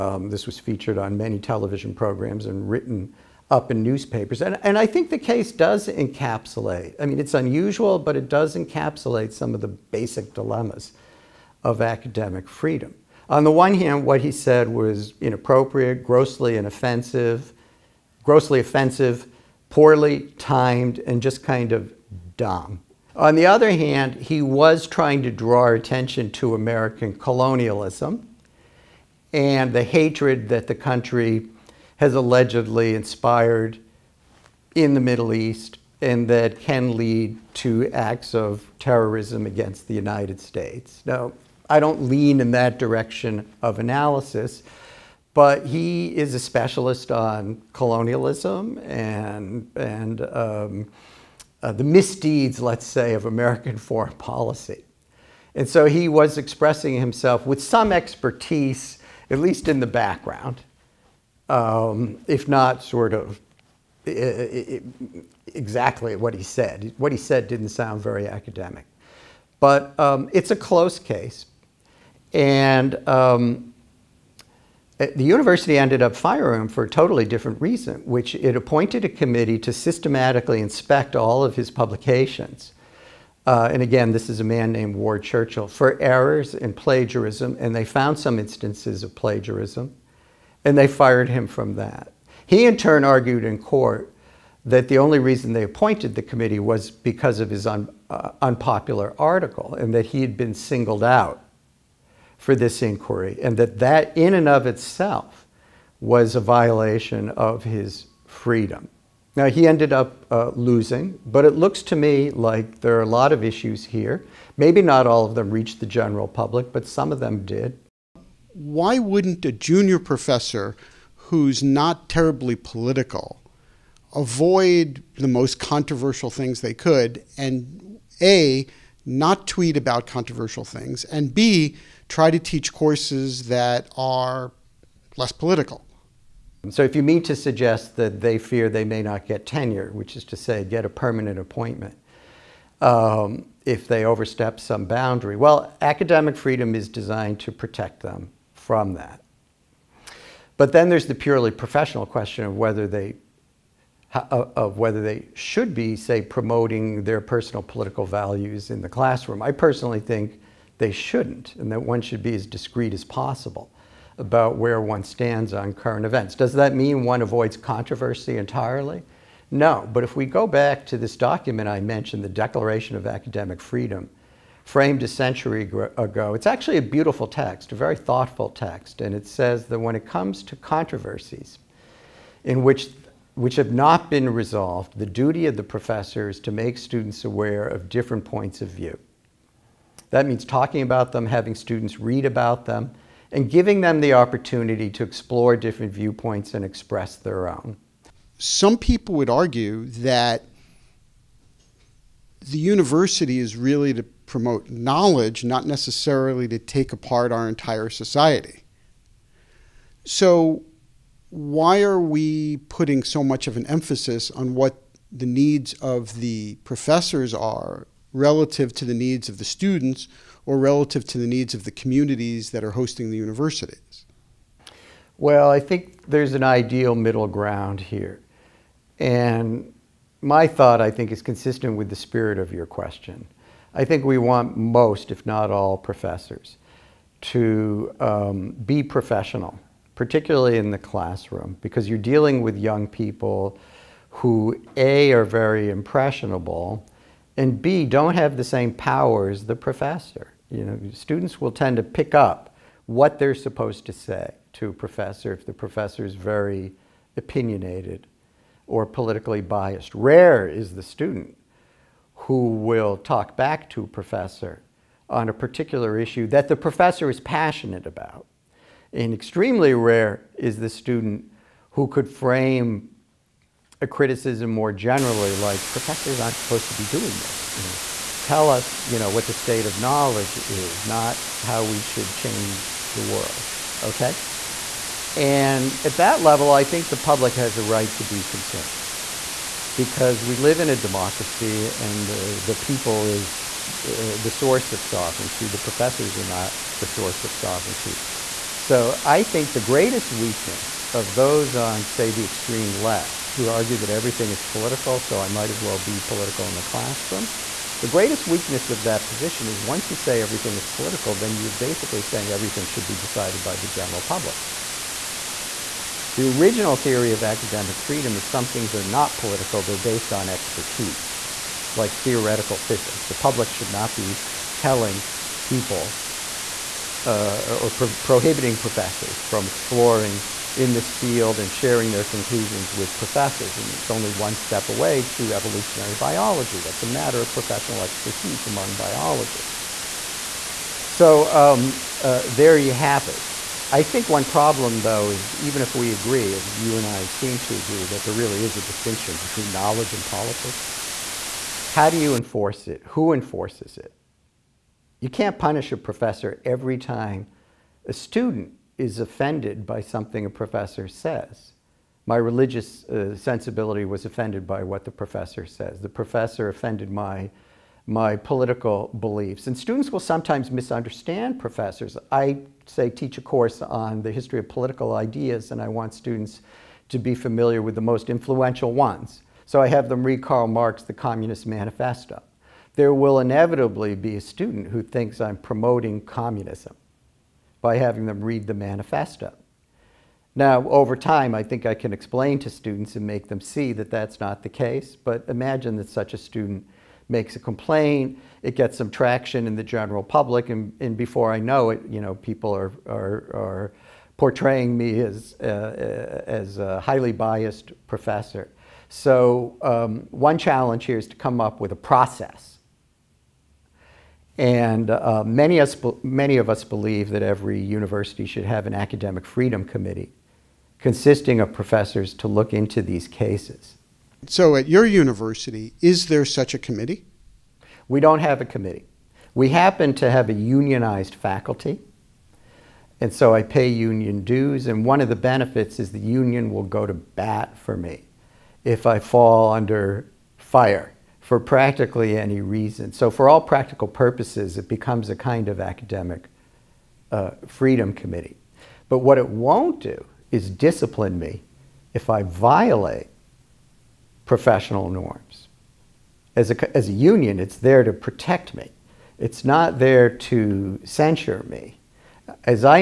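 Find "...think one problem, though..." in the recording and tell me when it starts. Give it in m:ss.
5:43.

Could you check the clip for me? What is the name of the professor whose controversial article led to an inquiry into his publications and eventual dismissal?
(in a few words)
Ward Churchill.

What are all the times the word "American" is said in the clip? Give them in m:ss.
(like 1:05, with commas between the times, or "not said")
0:26, 0:53.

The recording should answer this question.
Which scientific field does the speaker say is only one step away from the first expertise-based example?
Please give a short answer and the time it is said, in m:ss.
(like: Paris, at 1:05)
Evolutionary biology, at 5:35.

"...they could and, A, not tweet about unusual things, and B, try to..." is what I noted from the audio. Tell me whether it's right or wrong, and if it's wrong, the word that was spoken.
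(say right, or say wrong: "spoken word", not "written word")
wrong: "controversial", not "unusual".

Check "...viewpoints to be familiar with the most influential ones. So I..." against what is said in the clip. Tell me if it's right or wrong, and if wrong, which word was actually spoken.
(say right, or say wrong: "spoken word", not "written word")
wrong: "students", not "viewpoints".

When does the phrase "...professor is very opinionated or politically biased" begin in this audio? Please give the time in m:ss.
4:15.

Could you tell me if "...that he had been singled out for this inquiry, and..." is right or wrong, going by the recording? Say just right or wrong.
right.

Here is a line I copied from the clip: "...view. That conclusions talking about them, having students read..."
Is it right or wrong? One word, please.
wrong.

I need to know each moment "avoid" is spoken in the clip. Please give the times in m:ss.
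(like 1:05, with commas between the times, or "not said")
2:04, 2:47.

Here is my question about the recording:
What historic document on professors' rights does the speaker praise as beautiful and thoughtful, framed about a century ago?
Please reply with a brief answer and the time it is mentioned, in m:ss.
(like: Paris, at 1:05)
Declaration of Academic Freedom, at 2:52.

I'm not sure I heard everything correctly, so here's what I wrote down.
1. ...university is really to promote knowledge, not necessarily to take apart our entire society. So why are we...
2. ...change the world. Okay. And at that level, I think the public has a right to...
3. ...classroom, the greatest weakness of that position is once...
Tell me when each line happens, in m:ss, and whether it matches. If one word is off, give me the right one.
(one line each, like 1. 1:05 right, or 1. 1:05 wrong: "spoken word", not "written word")
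1. 3:22 right
2. 4:42 right
3. 5:06 right.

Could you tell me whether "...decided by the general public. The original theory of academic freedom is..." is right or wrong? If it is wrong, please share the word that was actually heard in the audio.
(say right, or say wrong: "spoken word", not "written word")
right.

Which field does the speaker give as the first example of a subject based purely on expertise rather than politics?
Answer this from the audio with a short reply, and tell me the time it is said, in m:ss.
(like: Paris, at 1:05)
Theoretical physics, at 5:21.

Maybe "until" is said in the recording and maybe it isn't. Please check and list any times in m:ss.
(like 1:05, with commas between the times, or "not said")
not said.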